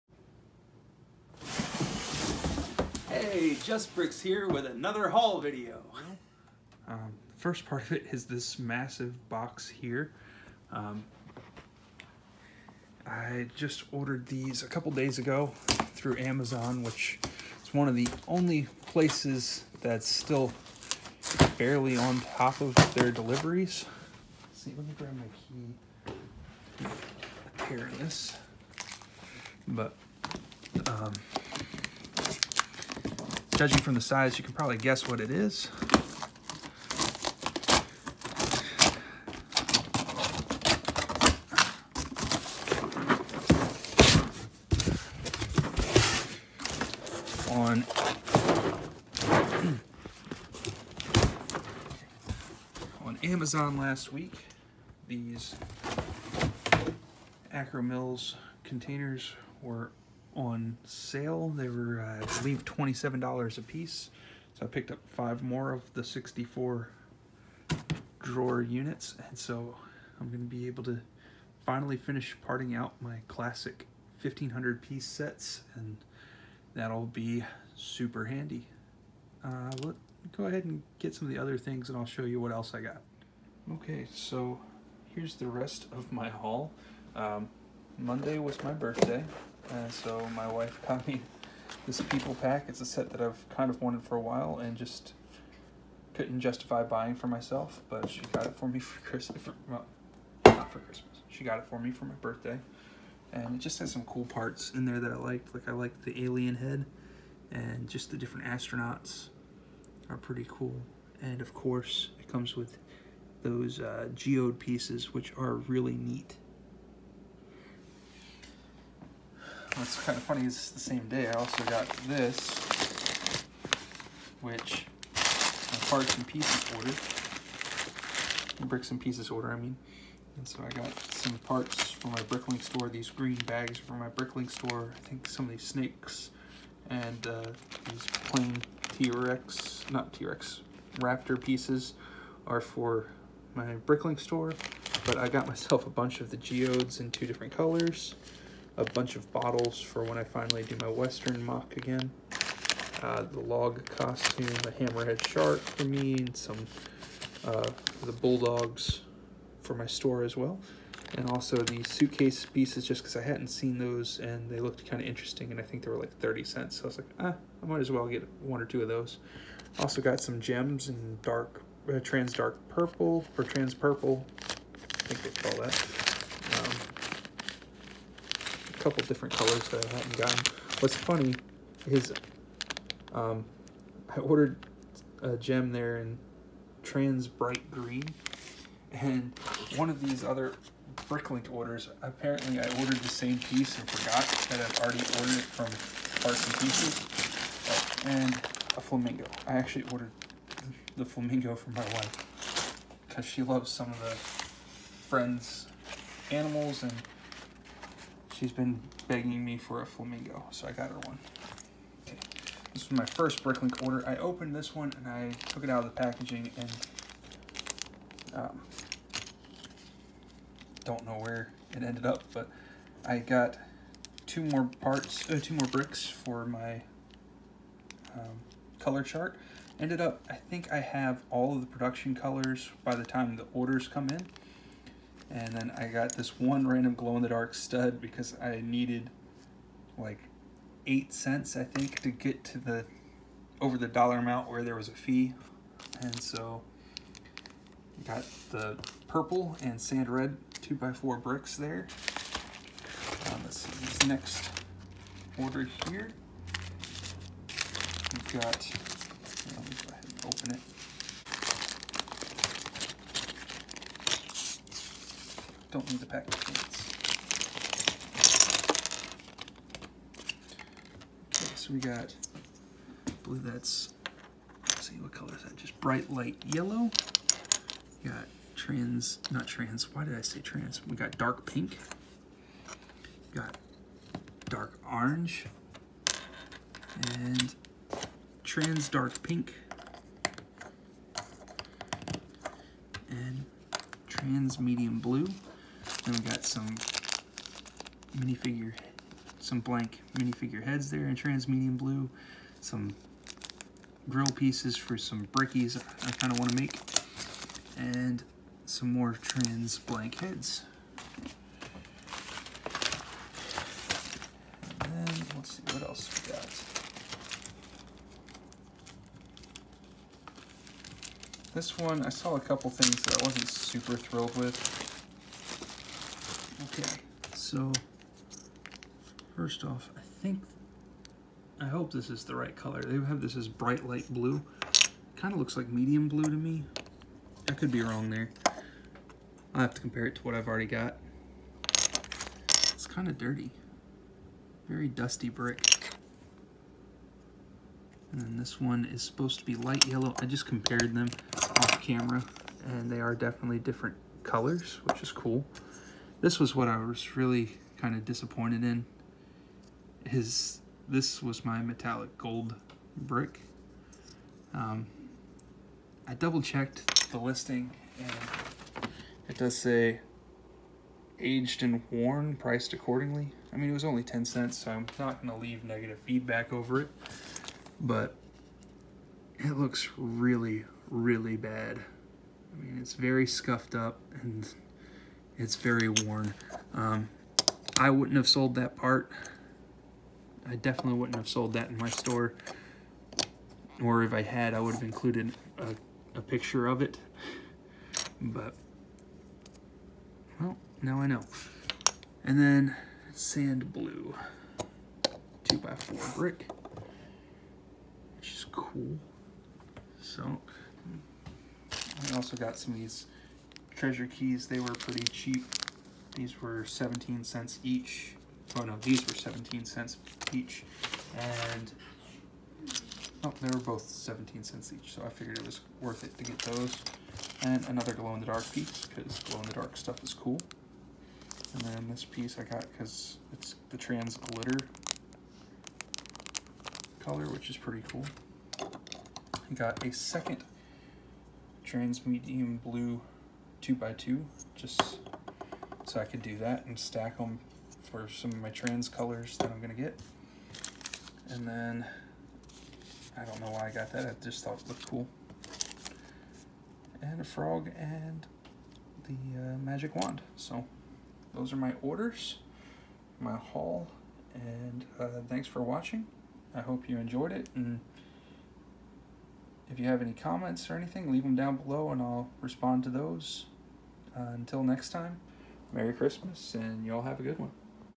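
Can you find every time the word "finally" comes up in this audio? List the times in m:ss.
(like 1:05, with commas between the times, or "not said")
1:11, 2:30.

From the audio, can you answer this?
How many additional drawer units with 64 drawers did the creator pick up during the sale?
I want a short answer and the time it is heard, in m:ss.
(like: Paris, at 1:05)
5, at 1:05.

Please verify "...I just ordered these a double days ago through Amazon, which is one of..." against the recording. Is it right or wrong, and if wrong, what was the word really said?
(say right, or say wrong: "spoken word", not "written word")
wrong: "couple", not "double".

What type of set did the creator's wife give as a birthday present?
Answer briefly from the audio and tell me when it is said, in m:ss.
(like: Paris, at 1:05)
People Pack, at 1:32.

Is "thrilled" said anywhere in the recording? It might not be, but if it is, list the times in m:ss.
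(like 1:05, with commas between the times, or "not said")
5:23.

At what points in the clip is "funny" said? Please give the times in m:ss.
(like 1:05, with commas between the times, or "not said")
2:00, 3:00.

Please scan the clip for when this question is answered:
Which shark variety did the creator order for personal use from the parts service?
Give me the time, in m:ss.
2:34.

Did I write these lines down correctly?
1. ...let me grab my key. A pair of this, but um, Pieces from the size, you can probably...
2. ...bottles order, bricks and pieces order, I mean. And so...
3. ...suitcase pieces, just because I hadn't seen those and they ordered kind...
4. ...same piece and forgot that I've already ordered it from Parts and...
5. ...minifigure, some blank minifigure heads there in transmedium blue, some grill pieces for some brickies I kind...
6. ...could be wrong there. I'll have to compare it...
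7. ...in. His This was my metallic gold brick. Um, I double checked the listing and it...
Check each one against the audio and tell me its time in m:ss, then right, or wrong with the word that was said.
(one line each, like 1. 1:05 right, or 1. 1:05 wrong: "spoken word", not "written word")
1. 0:24 wrong: "Judging", not "Pieces"
2. 2:06 wrong: "pieces", not "bottles"
3. 2:41 wrong: "looked", not "ordered"
4. 3:13 right
5. 4:58 right
6. 5:37 right
7. 5:58 right.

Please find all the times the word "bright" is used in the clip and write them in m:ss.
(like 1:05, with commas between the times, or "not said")
3:07, 4:35, 5:33.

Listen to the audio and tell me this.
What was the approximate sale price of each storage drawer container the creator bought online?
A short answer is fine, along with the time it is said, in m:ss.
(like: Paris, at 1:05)
$27, at 1:02.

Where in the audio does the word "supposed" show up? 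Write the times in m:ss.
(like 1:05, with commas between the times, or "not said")
5:49.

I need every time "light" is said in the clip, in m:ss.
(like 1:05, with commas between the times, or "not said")
4:36, 5:33, 5:49.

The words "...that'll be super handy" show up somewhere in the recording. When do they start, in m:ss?
1:16.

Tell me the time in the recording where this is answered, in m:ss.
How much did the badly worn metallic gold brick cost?
6:14.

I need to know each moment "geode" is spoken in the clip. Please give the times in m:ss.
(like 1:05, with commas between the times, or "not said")
1:54, 2:26.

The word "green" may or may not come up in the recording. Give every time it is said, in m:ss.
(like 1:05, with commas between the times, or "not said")
2:13, 3:07.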